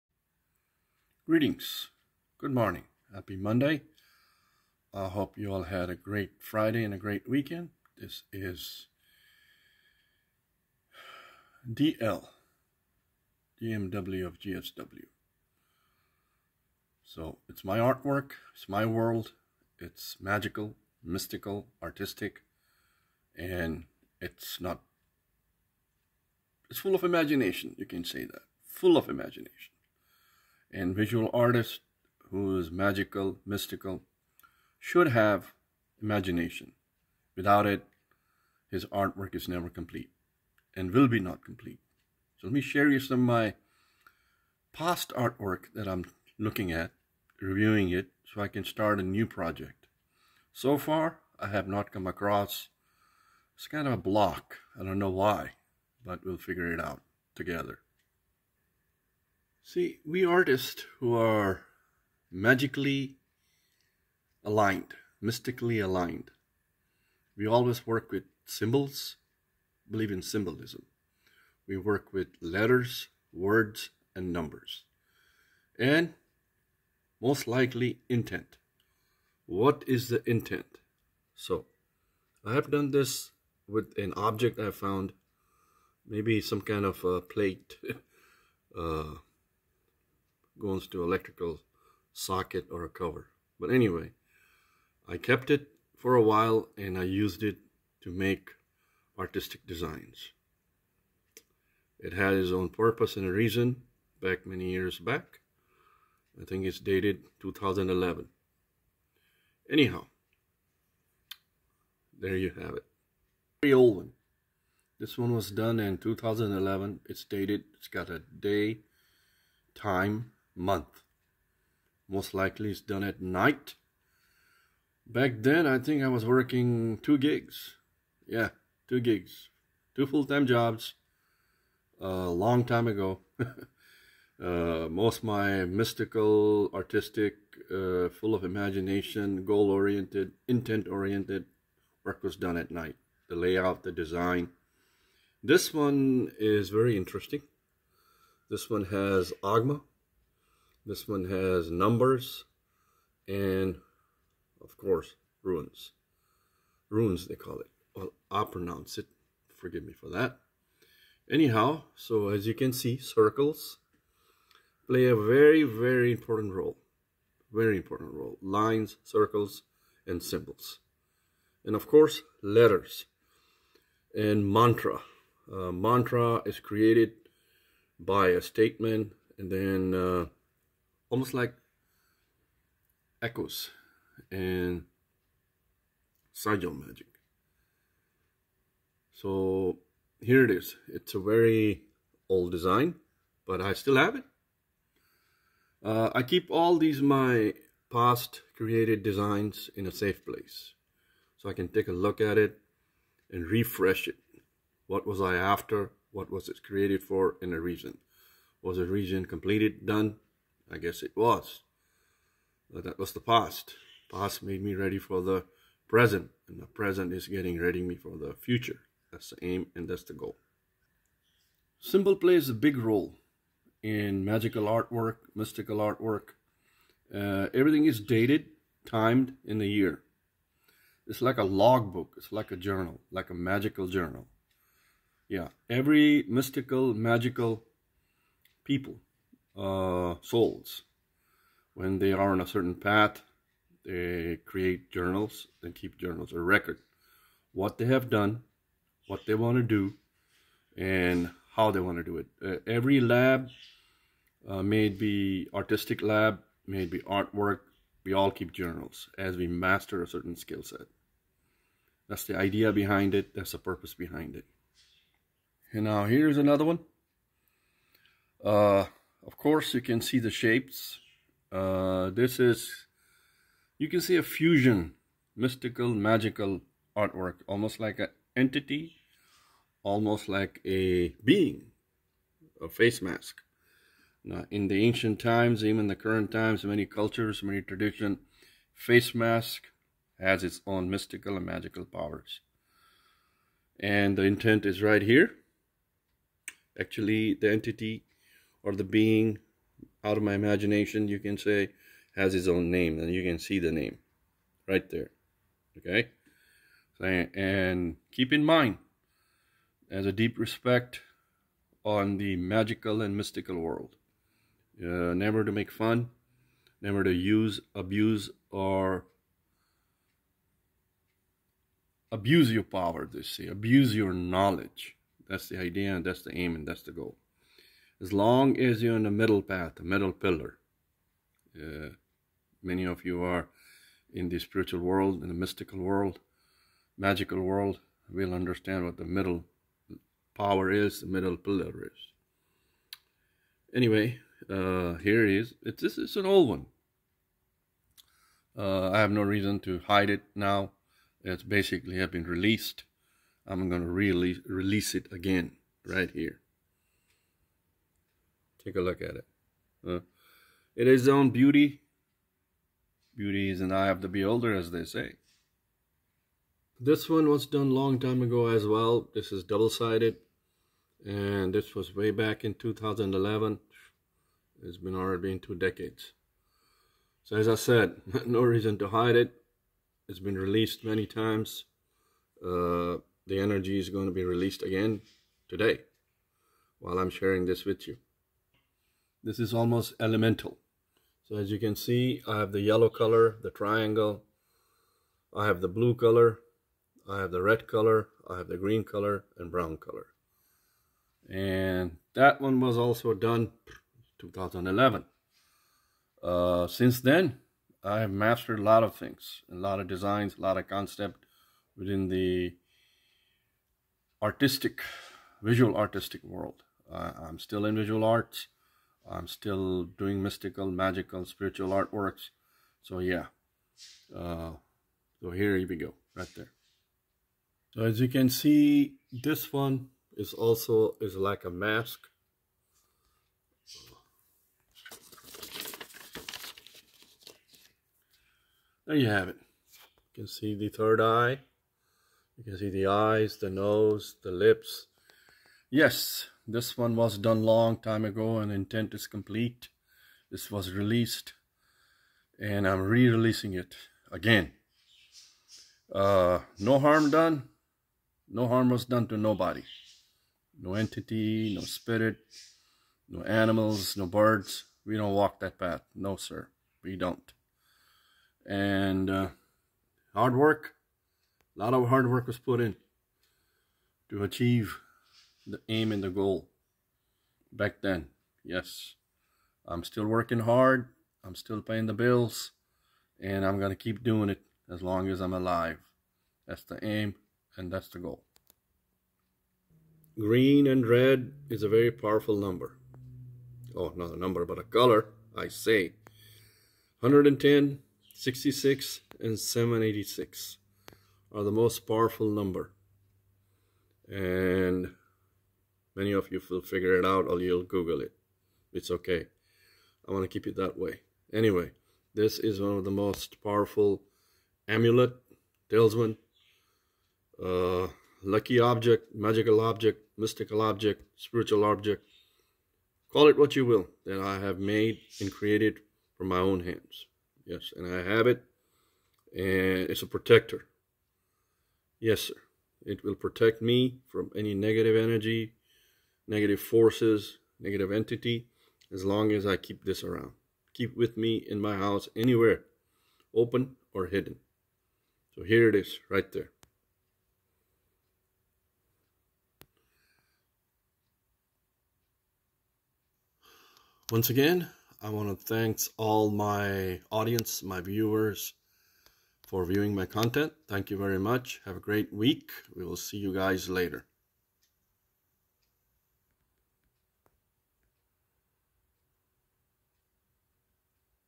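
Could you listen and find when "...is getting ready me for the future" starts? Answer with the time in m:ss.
3:37.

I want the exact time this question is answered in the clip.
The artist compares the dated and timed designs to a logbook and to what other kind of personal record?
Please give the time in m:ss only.
3:53.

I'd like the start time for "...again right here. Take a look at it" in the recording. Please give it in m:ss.
5:55.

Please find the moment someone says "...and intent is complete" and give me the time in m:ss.
7:28.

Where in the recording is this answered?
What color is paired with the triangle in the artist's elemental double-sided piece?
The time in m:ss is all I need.
6:32.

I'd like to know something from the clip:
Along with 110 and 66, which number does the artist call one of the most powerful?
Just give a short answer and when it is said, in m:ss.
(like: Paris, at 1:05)
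786, at 8:19.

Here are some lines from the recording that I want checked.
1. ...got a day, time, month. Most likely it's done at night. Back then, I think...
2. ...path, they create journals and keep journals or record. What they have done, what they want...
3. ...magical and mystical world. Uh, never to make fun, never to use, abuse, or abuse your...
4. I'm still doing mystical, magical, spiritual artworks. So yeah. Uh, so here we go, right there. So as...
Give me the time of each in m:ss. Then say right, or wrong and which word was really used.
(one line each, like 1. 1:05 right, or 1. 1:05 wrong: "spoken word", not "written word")
1. 1:57 right
2. 4:02 right
3. 5:12 right
4. 6:59 right.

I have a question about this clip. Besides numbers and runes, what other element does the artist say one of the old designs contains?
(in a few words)
Agma.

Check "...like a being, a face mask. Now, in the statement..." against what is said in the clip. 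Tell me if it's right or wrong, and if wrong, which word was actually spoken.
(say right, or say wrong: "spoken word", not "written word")
wrong: "ancient", not "statement".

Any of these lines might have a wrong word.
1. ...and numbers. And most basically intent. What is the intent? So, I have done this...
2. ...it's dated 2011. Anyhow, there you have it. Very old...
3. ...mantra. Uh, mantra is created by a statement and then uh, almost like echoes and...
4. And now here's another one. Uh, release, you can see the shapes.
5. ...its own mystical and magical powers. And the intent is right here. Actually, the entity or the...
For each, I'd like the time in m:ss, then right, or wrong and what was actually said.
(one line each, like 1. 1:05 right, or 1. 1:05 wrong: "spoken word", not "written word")
1. 1:14 wrong: "likely", not "basically"
2. 1:46 right
3. 2:54 right
4. 4:25 wrong: "course", not "release"
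5. 4:50 right.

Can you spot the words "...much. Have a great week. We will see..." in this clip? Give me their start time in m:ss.
9:21.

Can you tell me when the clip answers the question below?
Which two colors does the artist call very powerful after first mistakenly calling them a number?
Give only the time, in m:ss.
8:10.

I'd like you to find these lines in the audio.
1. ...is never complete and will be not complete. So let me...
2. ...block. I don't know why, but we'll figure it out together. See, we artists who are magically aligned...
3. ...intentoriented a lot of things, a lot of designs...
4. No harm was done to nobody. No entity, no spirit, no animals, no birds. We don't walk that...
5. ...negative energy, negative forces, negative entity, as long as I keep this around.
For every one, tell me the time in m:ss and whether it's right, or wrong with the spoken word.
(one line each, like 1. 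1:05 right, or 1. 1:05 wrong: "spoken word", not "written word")
1. 0:39 right
2. 0:53 right
3. 6:48 wrong: "mastered", not "intentoriented"
4. 7:38 right
5. 8:54 right.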